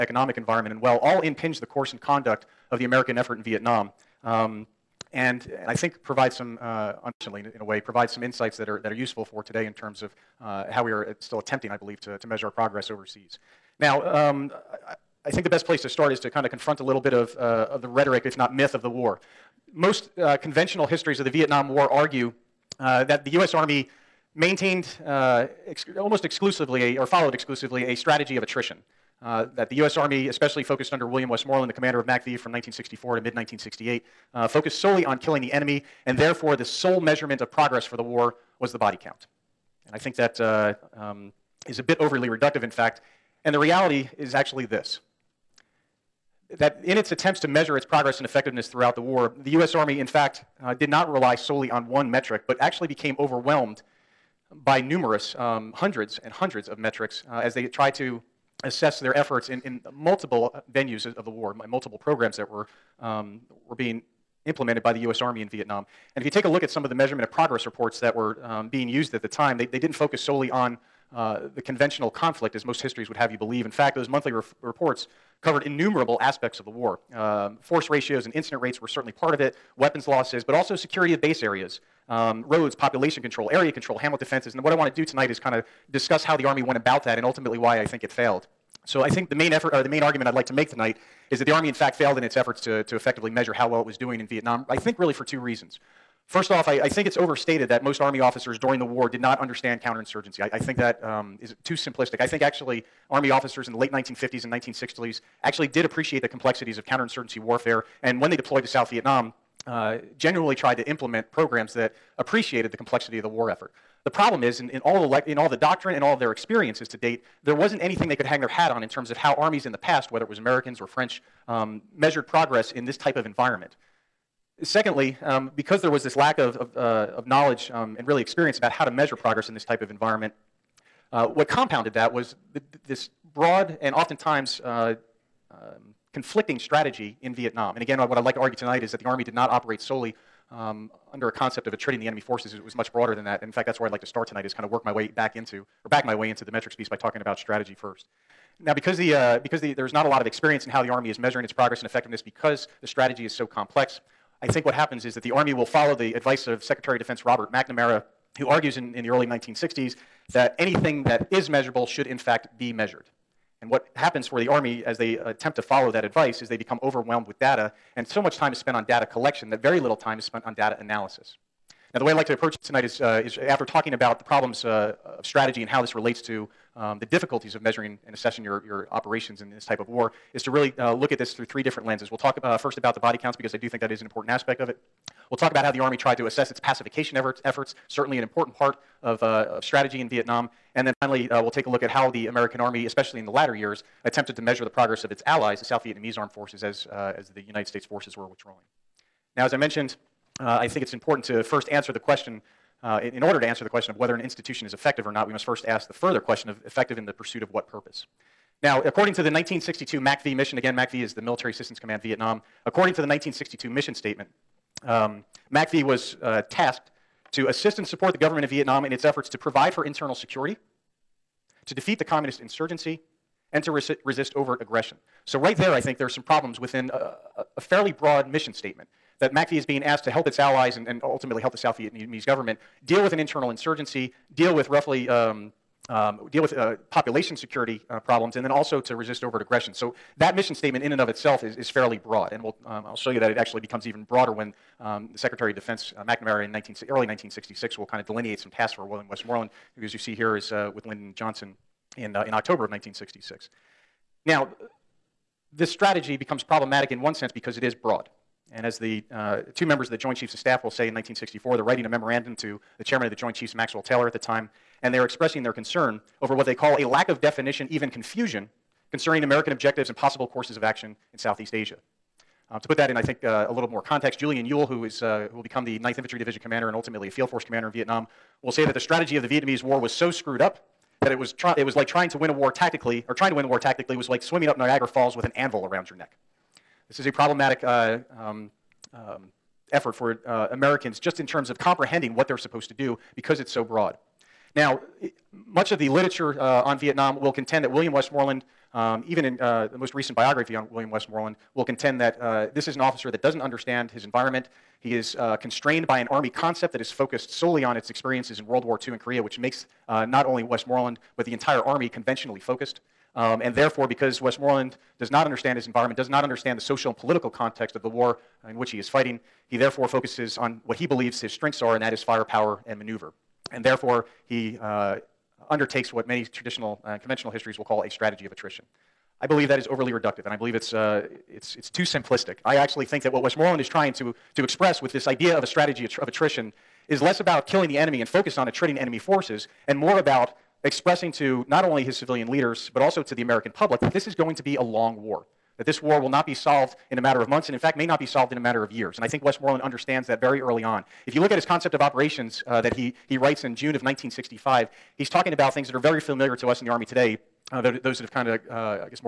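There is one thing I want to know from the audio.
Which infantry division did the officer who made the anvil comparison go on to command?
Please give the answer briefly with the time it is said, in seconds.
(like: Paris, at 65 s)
9th Infantry Division, at 275 s.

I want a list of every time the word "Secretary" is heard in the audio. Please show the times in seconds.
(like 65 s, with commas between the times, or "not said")
156 s, 245 s.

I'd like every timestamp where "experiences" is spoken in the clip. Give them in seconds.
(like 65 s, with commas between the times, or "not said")
116 s, 128 s, 150 s, 307 s.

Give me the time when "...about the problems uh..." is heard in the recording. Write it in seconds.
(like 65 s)
173 s.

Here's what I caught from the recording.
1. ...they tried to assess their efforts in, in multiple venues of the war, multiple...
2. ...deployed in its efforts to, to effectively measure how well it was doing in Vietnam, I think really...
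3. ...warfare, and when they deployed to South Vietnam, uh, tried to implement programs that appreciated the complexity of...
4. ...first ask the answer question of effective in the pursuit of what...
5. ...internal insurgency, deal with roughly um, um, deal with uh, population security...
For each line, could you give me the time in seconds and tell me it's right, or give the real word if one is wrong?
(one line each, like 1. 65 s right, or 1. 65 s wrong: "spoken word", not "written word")
1. 57 s right
2. 91 s wrong: "failed", not "deployed"
3. 107 s right
4. 205 s wrong: "further", not "answer"
5. 233 s right.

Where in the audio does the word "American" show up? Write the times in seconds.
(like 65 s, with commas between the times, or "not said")
2 s, 120 s, 192 s, 269 s, 290 s, 343 s.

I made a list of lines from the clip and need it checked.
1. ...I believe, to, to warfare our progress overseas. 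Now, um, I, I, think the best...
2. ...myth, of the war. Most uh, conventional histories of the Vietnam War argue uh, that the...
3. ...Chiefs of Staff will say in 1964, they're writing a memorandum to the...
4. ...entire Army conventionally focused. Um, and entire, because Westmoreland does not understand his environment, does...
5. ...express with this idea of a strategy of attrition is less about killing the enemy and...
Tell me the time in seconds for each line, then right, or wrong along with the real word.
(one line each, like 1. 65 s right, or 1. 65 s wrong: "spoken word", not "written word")
1. 11 s wrong: "measure", not "warfare"
2. 18 s right
3. 260 s right
4. 311 s wrong: "therefore", not "entire"
5. 334 s right.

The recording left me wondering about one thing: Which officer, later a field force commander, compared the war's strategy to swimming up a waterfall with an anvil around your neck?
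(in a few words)
Julian Ewell.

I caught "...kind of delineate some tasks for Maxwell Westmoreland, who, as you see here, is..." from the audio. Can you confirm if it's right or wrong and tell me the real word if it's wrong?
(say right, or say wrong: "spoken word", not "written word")
wrong: "William", not "Maxwell".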